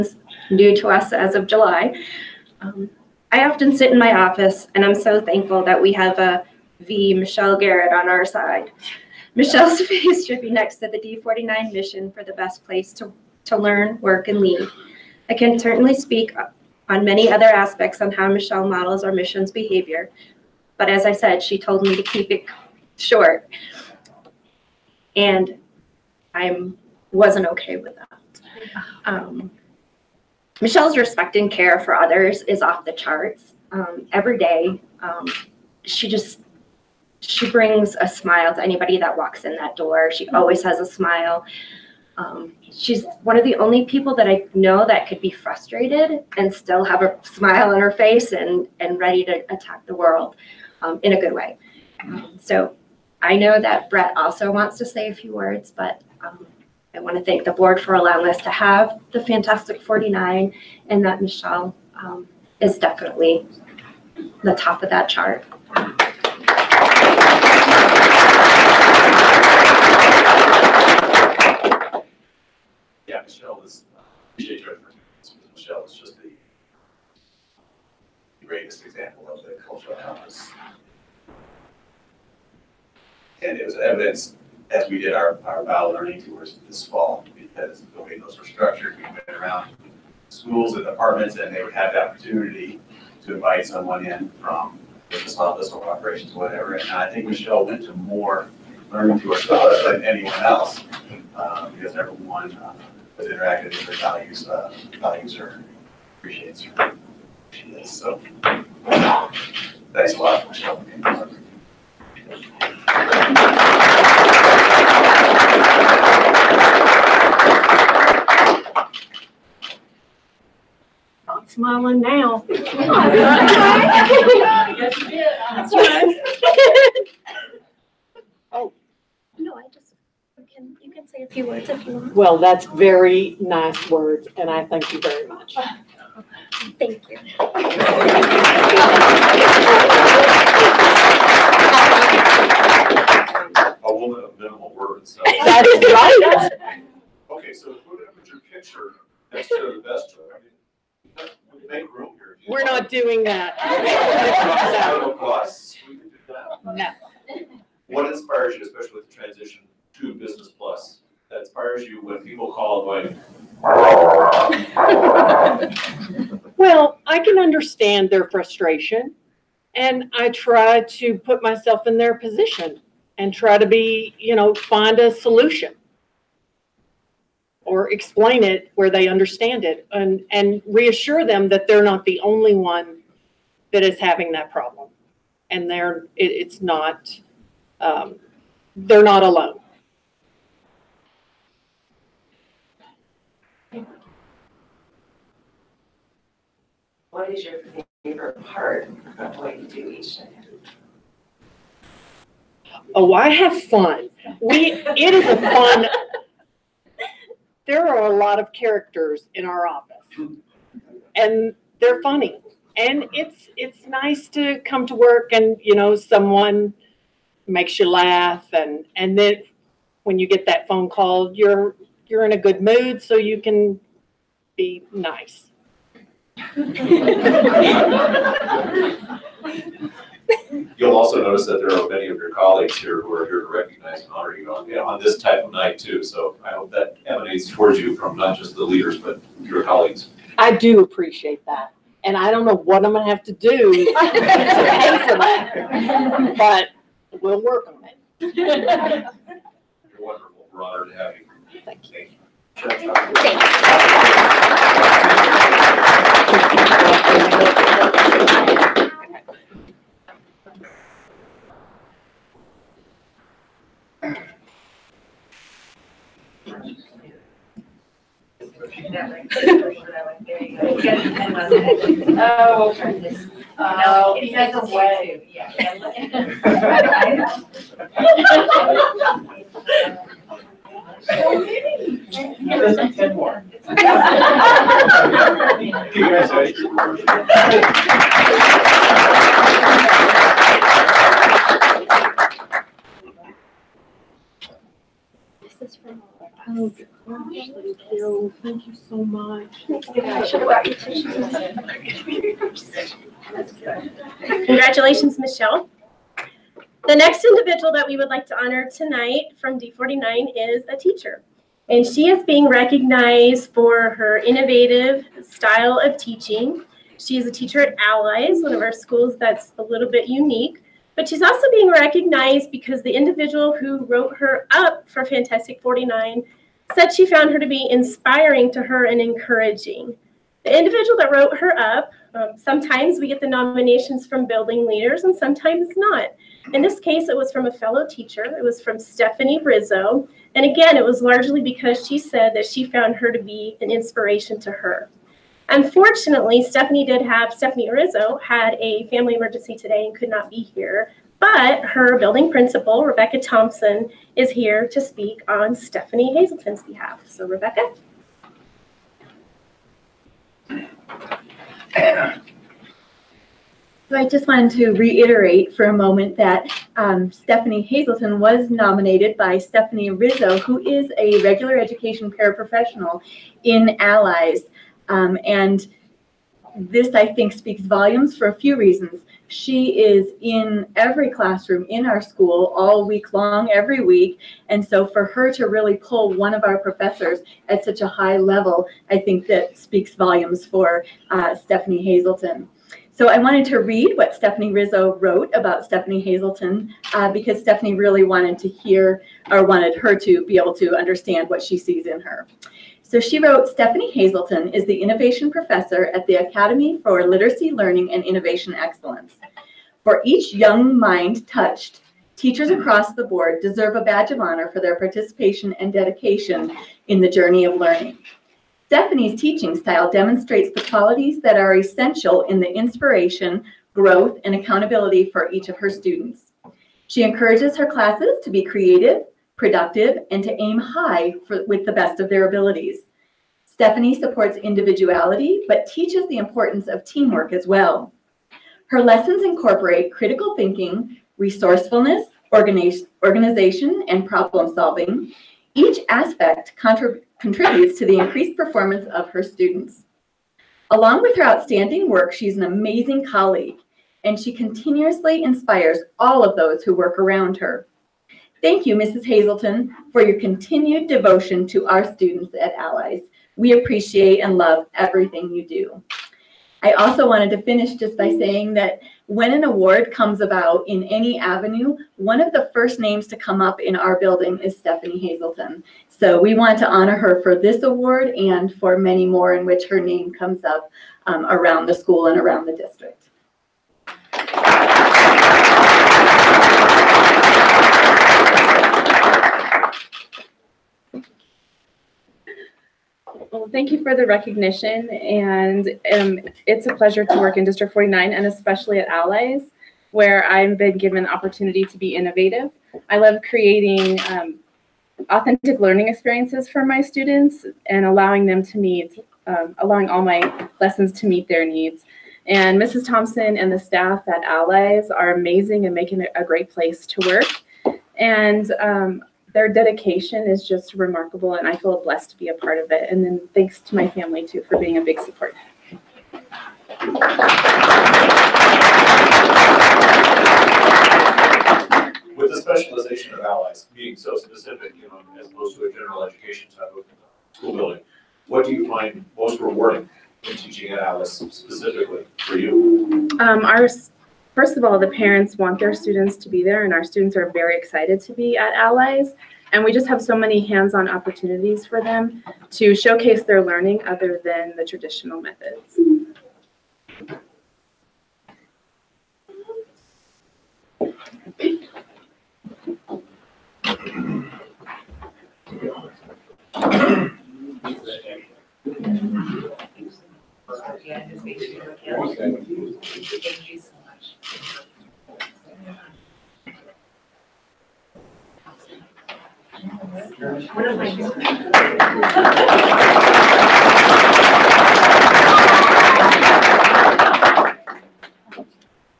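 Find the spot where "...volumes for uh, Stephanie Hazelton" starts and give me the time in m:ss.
6:29.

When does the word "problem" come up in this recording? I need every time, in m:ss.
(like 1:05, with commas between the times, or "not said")
3:04, 7:24.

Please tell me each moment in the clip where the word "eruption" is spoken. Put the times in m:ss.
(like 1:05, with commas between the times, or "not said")
not said.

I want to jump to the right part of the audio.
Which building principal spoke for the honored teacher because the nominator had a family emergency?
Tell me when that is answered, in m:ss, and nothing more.
5:52.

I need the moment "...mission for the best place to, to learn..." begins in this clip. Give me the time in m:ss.
0:11.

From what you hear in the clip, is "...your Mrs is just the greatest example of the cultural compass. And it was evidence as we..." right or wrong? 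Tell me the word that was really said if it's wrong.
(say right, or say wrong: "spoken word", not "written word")
wrong: "Michelle", not "Mrs".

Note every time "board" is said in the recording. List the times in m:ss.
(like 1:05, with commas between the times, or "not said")
0:57, 6:53.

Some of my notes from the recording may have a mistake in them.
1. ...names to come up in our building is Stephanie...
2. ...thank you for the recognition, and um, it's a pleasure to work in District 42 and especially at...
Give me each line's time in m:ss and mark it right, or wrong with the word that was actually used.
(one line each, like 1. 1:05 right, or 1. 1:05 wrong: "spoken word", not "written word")
1. 7:52 right
2. 8:13 wrong: "49", not "42".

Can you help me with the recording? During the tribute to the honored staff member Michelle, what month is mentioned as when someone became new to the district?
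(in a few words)
July.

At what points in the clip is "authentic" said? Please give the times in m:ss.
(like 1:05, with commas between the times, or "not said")
8:25.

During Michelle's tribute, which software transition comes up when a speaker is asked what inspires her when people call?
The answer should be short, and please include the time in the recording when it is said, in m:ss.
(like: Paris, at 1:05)
Business Plus, at 2:40.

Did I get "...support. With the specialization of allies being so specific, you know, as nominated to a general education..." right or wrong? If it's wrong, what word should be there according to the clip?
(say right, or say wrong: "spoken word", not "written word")
wrong: "opposed", not "nominated".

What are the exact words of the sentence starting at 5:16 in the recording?
She is a teacher at Allies, one of our schools that's a little bit unique.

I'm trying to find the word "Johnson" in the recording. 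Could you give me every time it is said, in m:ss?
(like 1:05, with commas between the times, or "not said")
not said.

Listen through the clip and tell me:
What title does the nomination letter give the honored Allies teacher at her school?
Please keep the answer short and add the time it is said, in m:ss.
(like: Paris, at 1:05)
Innovation Professor, at 6:44.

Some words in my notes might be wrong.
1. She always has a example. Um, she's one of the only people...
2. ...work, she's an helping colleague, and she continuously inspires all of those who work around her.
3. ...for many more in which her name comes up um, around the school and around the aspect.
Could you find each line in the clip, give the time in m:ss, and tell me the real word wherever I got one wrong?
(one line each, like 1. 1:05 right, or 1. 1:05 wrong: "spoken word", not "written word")
1. 0:40 wrong: "smile", not "example"
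2. 7:31 wrong: "amazing", not "helping"
3. 7:58 wrong: "district", not "aspect".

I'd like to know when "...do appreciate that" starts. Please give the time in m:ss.
4:00.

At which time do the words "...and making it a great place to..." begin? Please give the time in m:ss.
8:35.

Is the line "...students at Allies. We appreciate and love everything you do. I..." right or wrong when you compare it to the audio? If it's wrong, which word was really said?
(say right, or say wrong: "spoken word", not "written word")
right.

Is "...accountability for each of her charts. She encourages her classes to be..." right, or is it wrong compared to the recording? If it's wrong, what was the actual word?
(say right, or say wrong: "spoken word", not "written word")
wrong: "students", not "charts".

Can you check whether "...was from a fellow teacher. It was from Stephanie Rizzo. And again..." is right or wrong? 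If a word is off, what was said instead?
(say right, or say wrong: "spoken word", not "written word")
right.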